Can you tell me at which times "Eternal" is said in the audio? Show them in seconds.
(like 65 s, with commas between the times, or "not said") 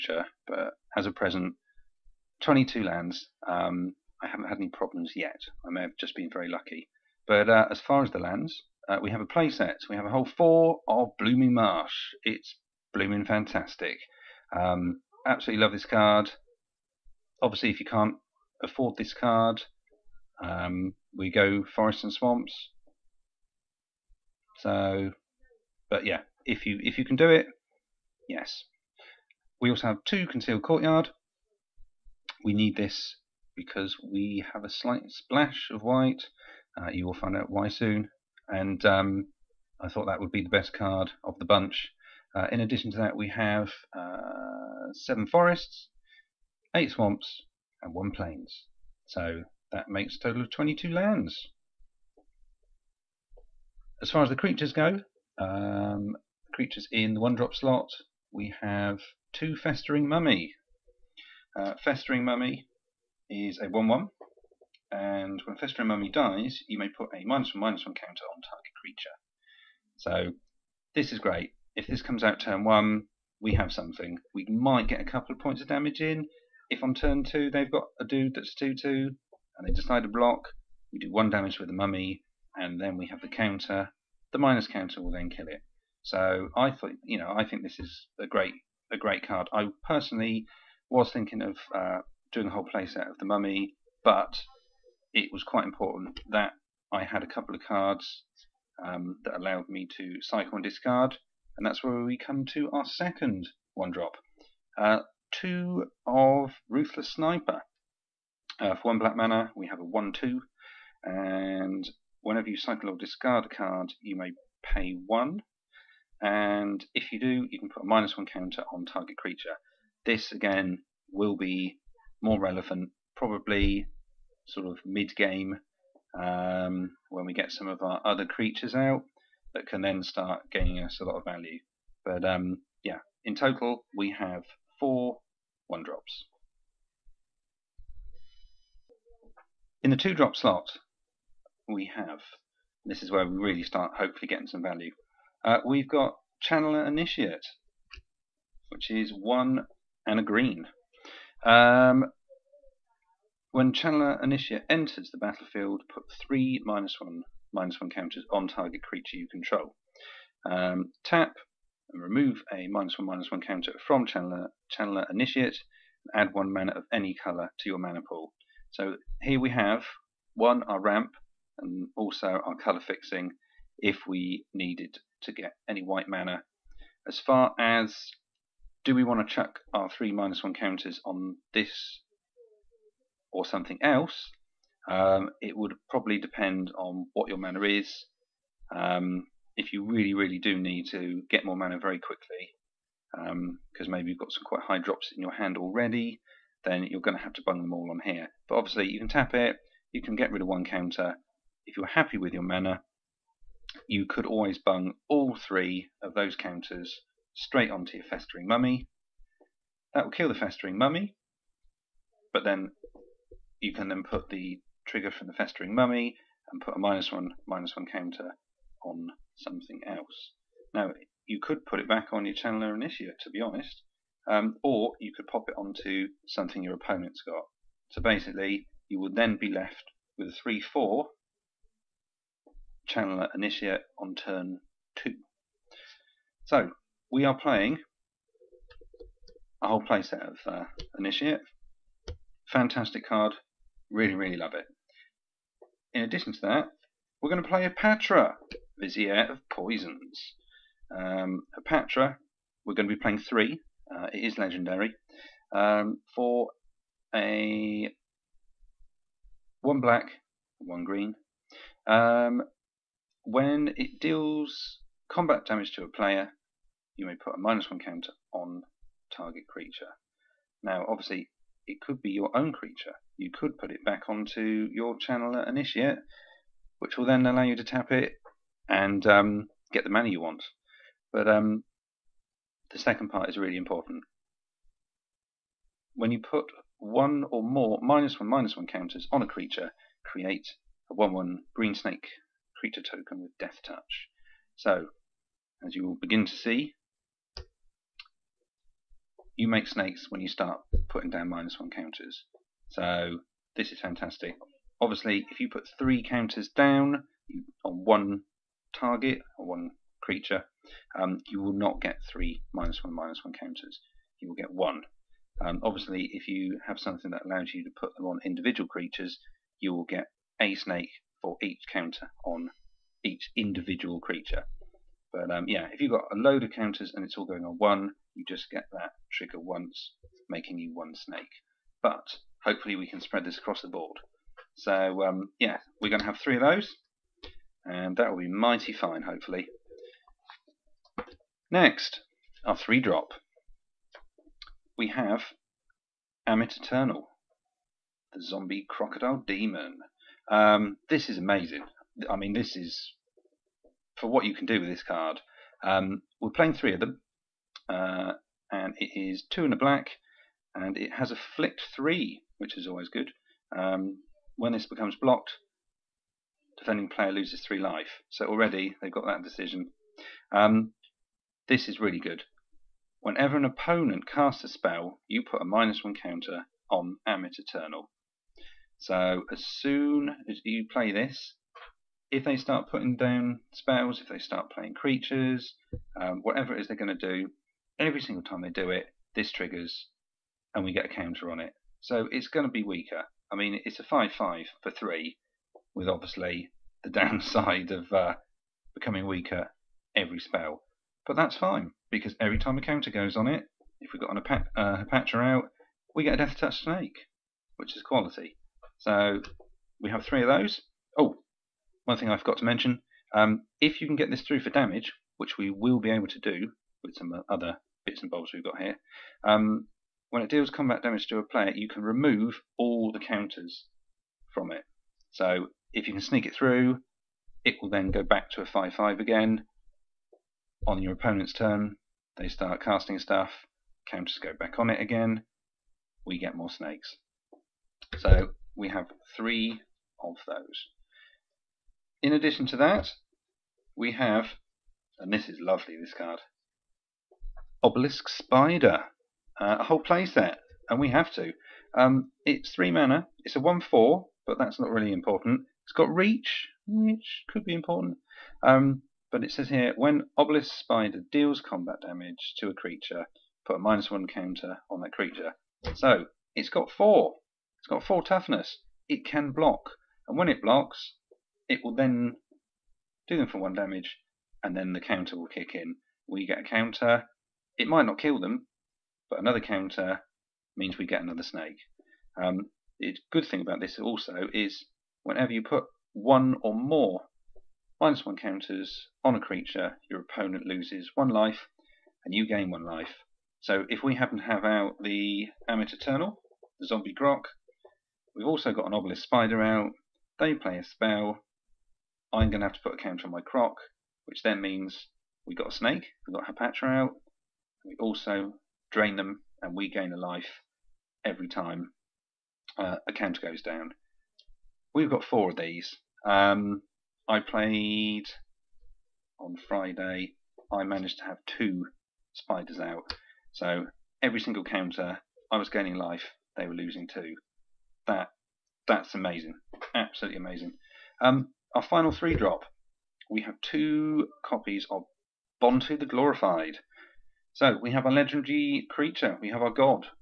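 346 s, 377 s, 495 s.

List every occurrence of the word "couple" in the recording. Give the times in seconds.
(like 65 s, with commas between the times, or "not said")
75 s, 97 s.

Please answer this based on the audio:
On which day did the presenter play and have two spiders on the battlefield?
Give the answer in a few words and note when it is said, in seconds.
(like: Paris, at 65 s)
Friday, at 519 s.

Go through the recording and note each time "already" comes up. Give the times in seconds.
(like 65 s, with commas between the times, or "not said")
195 s, 368 s.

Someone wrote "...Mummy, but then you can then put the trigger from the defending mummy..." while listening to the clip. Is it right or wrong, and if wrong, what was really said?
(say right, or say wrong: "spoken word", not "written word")
wrong: "festering", not "defending".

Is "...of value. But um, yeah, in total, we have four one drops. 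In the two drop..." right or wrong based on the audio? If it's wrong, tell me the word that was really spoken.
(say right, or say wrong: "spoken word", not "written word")
right.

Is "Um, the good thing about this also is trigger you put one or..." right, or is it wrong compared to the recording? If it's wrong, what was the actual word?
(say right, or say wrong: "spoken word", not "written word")
wrong: "whenever", not "trigger".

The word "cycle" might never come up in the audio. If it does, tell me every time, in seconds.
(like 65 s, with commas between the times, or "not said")
100 s, 112 s.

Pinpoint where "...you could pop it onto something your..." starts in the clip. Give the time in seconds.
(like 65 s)
224 s.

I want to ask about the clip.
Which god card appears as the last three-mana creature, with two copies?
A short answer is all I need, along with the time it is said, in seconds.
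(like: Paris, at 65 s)
Bontu the Glorified, at 535 s.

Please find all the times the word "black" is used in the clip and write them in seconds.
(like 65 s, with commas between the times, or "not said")
108 s, 259 s, 359 s.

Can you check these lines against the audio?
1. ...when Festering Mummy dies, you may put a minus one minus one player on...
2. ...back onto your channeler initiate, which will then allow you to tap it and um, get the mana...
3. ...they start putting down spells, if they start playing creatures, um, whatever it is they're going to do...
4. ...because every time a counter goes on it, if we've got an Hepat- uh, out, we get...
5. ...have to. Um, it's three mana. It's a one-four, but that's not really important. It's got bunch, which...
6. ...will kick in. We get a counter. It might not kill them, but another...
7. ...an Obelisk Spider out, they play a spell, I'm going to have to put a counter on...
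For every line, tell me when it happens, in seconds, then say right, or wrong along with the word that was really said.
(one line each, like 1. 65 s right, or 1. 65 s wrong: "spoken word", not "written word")
1. 65 s wrong: "counter", not "player"
2. 273 s right
3. 382 s right
4. 401 s right
5. 450 s wrong: "reach", not "bunch"
6. 475 s right
7. 498 s right.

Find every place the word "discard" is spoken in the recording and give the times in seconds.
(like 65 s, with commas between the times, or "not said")
100 s, 112 s.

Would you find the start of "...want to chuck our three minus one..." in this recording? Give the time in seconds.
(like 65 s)
179 s.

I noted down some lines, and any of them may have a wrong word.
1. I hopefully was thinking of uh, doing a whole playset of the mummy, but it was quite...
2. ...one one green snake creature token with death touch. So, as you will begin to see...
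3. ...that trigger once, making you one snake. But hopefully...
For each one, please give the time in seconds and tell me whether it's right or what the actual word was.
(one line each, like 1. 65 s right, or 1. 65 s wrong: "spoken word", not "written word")
1. 89 s wrong: "personally", not "hopefully"
2. 290 s right
3. 328 s right.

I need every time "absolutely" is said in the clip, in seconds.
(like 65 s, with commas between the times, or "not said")
15 s, 529 s.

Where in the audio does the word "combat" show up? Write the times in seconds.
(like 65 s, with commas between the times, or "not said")
265 s, 420 s, 461 s.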